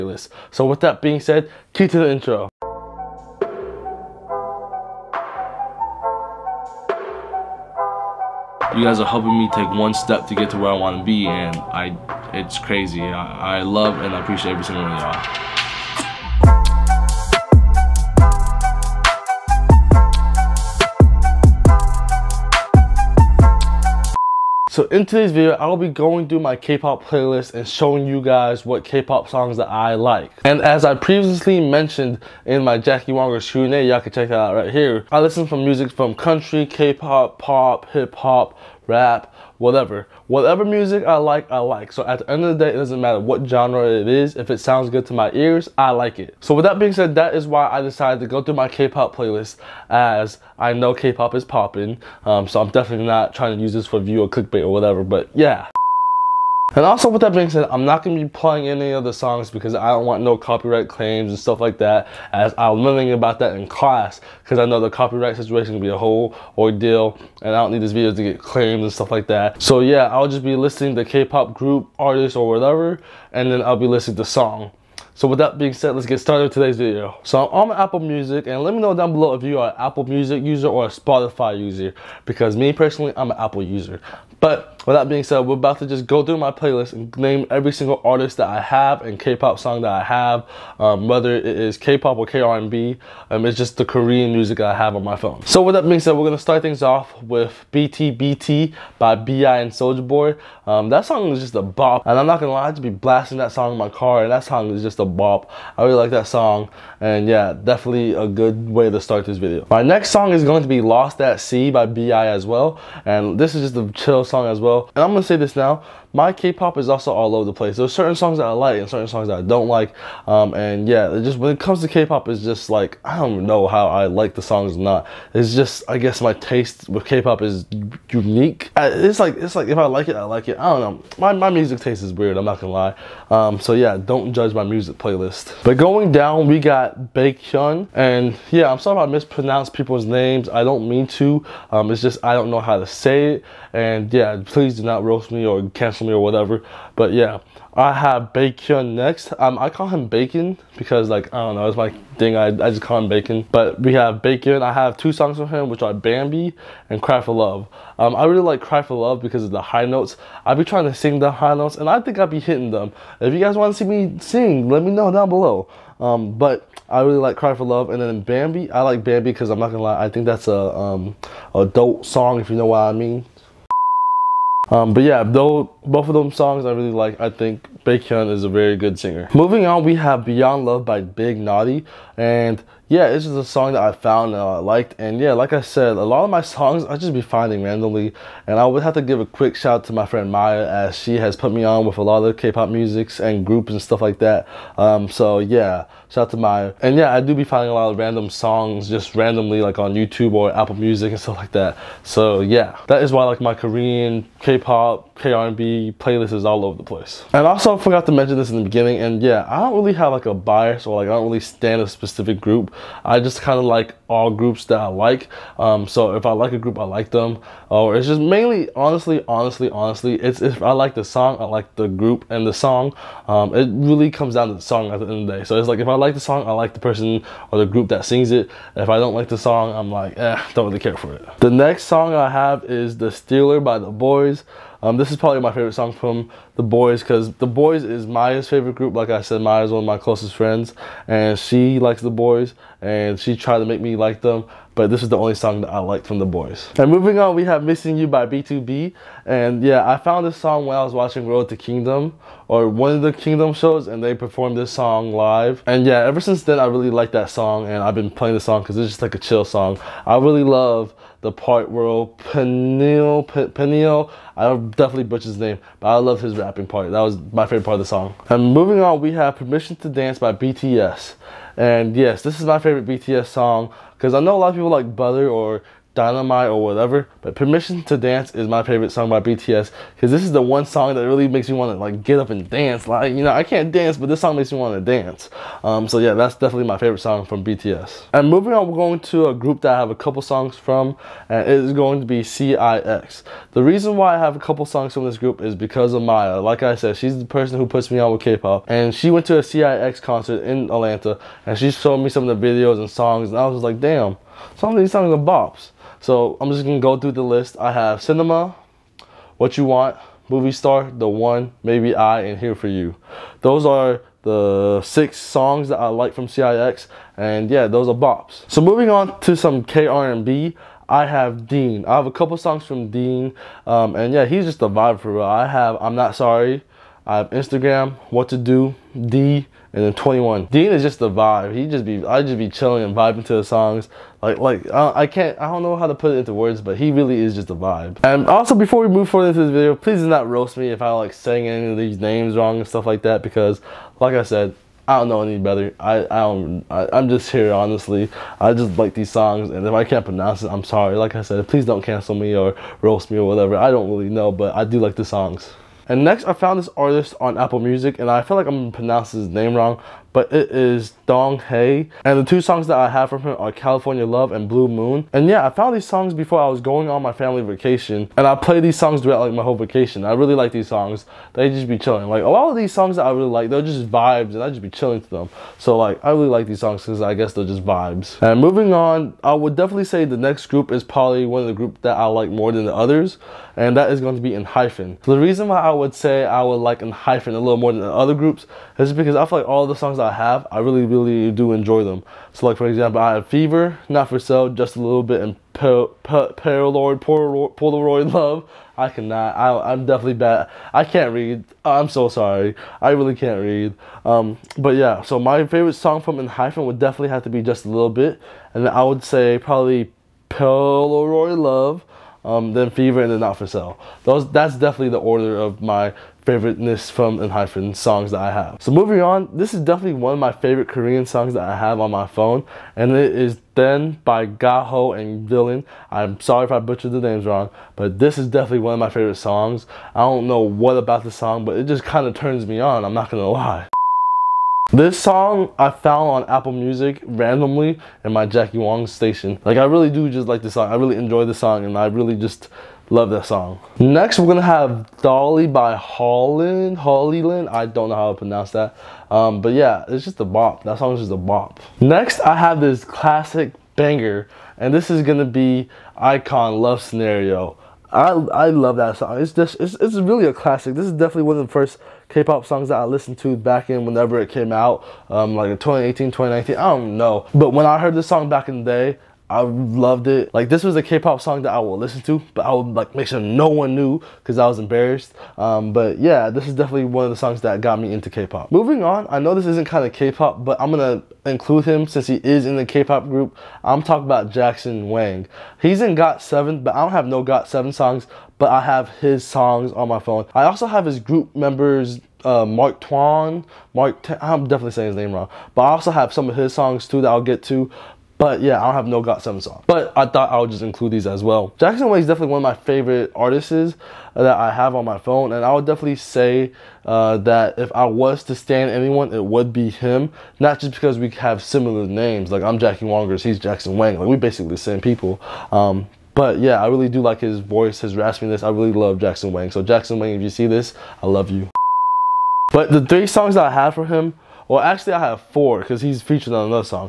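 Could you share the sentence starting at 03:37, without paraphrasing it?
Or oh, it's just mainly, honestly, honestly, honestly, it's if I like the song, I like the group and the song.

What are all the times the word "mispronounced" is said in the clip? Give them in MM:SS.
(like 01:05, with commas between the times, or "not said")
02:19.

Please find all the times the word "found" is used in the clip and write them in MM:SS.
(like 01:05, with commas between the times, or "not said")
03:03, 04:09, 05:56, 06:05, 07:15.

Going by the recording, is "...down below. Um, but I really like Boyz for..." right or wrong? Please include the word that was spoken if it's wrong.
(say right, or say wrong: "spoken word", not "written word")
wrong: "Cry", not "Boyz".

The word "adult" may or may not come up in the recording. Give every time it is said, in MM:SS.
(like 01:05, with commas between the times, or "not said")
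02:51.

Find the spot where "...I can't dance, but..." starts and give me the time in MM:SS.
04:43.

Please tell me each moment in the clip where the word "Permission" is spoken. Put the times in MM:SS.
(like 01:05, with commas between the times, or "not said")
04:29, 04:37.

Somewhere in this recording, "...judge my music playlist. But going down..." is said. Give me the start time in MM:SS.
02:14.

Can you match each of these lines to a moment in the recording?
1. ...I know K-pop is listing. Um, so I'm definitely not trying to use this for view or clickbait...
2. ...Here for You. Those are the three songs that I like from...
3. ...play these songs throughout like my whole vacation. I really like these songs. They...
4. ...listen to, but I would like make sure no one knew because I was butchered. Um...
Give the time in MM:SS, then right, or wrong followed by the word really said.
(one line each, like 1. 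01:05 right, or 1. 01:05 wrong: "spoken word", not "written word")
1. 00:50 wrong: "popping", not "listing"
2. 05:12 wrong: "six", not "three"
3. 06:08 right
4. 07:51 wrong: "embarrassed", not "butchered".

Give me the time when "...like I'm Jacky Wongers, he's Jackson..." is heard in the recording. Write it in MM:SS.
08:32.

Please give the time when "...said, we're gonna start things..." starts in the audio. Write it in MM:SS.
01:35.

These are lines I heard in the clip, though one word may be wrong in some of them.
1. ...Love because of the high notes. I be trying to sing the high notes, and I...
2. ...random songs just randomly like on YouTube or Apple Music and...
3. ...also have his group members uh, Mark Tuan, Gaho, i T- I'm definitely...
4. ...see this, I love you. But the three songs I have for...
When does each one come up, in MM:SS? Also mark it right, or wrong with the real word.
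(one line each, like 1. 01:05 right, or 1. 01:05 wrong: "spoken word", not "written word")
1. 02:38 right
2. 03:17 right
3. 08:10 wrong: "Mark", not "Gaho"
4. 08:40 right.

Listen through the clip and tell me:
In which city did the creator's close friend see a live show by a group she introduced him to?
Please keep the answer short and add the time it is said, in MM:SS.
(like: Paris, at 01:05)
Atlanta, at 05:00.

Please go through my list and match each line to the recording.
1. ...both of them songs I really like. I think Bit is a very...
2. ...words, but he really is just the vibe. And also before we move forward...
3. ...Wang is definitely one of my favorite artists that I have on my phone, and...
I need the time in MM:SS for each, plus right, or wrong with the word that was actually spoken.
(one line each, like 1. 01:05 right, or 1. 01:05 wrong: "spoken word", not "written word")
1. 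02:55 wrong: "Baekhyun", not "Bit"
2. 05:36 right
3. 08:21 right.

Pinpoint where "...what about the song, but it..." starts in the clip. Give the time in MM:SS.
07:10.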